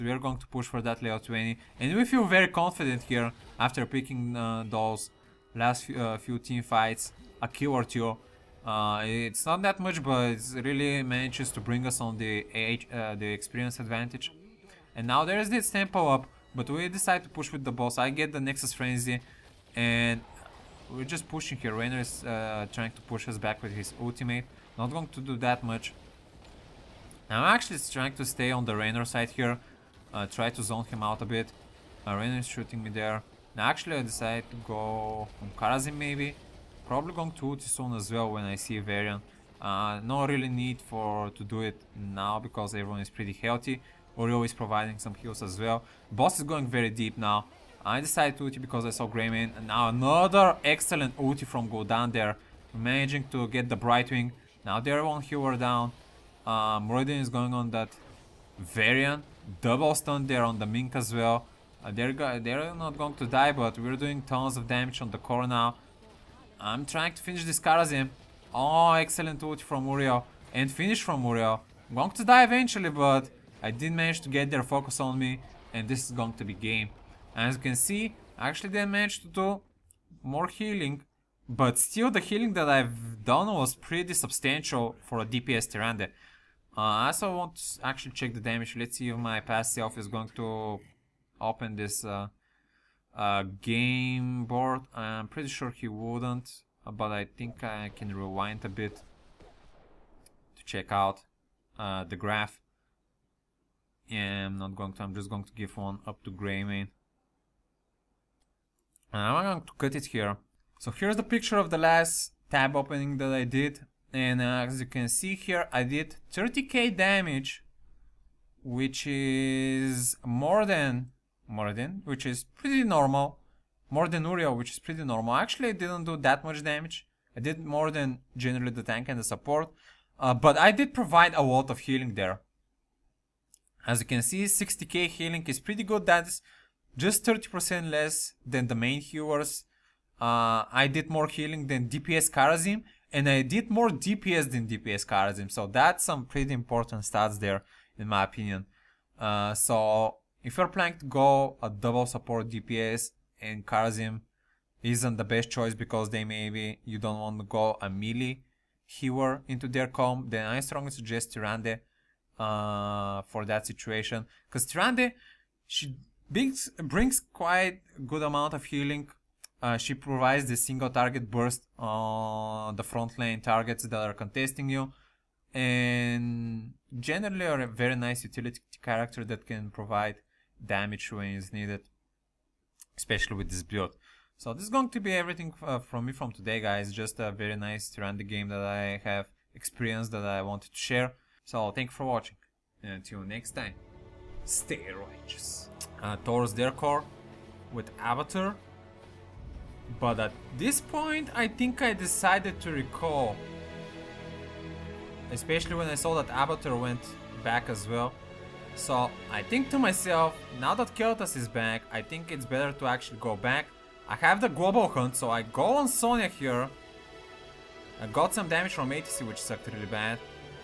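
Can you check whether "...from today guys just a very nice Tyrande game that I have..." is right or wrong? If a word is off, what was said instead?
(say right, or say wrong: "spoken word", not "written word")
right.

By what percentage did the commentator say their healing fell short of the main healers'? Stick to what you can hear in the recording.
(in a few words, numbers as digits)
30%.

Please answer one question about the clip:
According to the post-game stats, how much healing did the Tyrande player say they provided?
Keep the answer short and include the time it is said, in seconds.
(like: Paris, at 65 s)
60k, at 134 s.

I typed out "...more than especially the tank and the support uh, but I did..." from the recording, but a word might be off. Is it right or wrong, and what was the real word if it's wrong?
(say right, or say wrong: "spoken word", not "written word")
wrong: "generally", not "especially".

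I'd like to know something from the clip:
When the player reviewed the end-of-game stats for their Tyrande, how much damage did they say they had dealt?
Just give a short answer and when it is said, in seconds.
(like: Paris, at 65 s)
30k, at 116 s.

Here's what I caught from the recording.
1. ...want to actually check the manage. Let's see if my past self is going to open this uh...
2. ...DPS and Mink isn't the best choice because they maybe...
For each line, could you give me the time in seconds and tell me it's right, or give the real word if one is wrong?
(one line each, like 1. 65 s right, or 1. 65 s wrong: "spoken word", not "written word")
1. 87 s wrong: "damage", not "manage"
2. 152 s wrong: "Karazim", not "Mink".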